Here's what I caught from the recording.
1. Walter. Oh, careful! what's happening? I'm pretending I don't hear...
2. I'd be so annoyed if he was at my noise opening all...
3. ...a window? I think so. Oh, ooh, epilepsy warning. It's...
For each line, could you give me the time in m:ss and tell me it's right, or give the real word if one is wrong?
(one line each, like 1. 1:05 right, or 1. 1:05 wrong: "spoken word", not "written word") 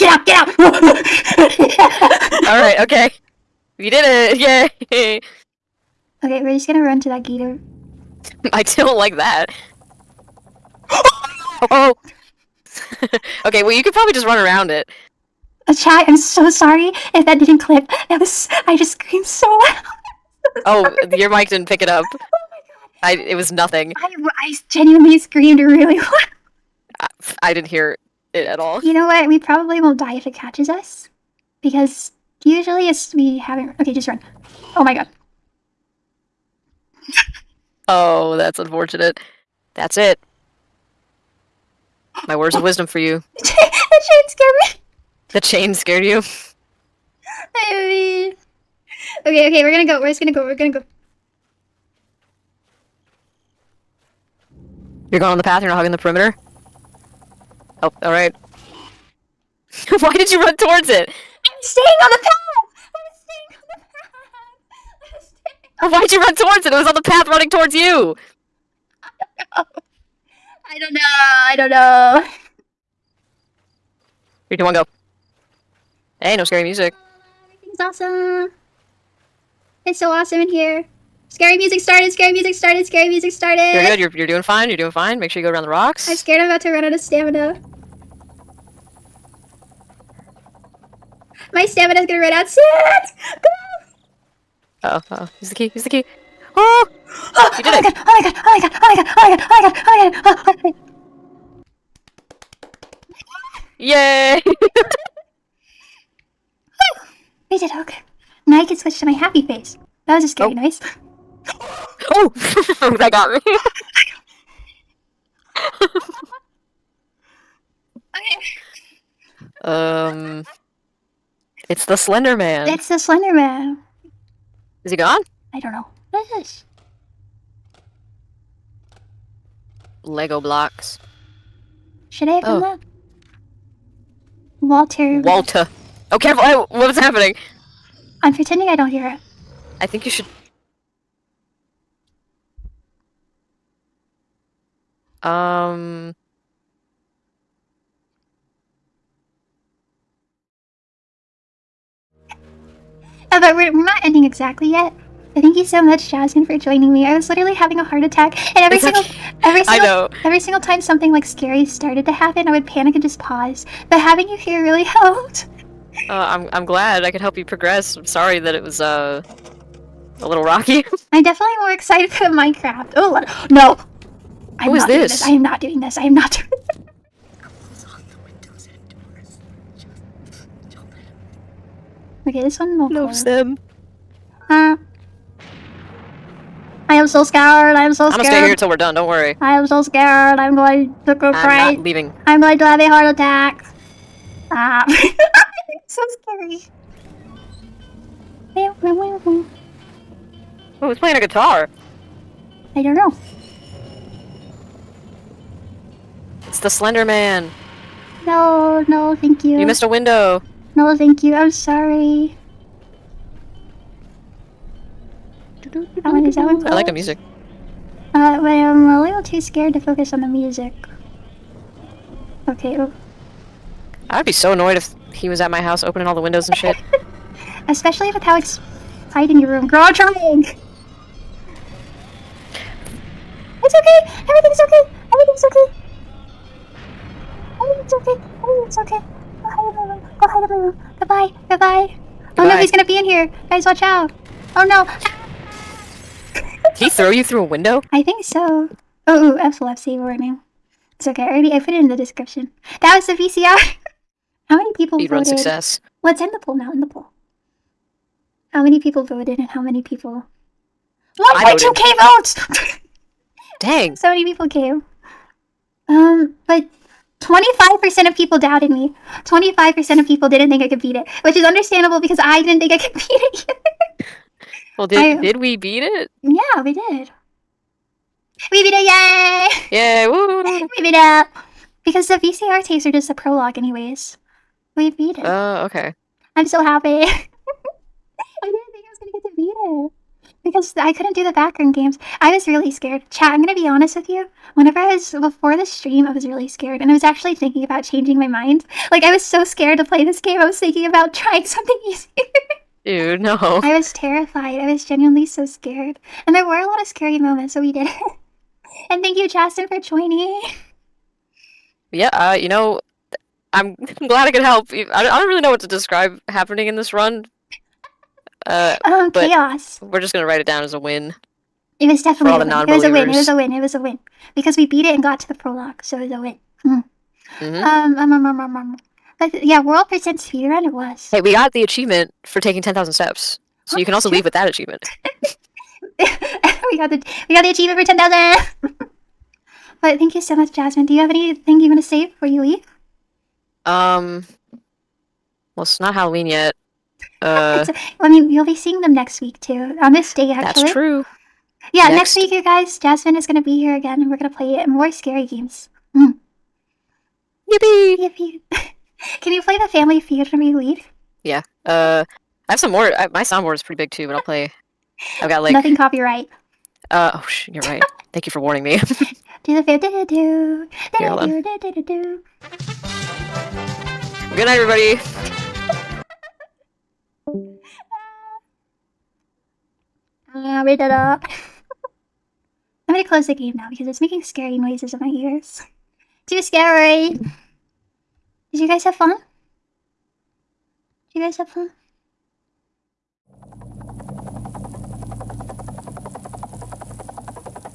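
1. 2:15 right
2. 3:44 wrong: "house", not "noise"
3. 4:07 right.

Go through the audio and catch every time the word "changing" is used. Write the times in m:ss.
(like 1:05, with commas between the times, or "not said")
4:57.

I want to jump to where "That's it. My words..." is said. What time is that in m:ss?
0:39.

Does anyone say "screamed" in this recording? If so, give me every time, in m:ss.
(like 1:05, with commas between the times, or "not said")
0:18, 0:25.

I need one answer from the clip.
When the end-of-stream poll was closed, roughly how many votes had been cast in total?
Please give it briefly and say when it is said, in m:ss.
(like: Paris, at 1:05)
1.2k, at 4:21.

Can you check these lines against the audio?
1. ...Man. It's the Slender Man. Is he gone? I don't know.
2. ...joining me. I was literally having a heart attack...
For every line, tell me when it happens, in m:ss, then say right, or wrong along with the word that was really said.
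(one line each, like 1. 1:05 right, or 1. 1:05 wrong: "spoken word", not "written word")
1. 2:02 right
2. 2:36 right.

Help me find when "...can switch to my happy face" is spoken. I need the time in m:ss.
1:48.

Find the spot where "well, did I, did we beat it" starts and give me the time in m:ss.
4:34.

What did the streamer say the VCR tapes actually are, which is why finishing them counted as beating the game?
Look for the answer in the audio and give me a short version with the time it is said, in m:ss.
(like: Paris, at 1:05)
a prologue, at 4:43.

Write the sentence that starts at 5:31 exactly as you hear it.
Hey, we got the achievement for taking 10,000 steps.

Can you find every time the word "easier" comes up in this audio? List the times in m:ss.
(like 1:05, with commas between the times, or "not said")
5:01.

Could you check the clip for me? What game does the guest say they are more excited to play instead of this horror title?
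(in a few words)
Minecraft.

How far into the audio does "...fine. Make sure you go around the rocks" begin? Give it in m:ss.
1:24.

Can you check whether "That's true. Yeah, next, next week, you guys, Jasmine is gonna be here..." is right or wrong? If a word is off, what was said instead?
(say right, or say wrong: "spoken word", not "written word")
right.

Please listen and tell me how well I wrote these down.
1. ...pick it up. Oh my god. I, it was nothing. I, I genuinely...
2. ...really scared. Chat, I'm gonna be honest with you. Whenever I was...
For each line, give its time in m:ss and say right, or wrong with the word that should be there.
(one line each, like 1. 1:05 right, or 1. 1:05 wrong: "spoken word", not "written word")
1. 0:21 right
2. 4:52 right.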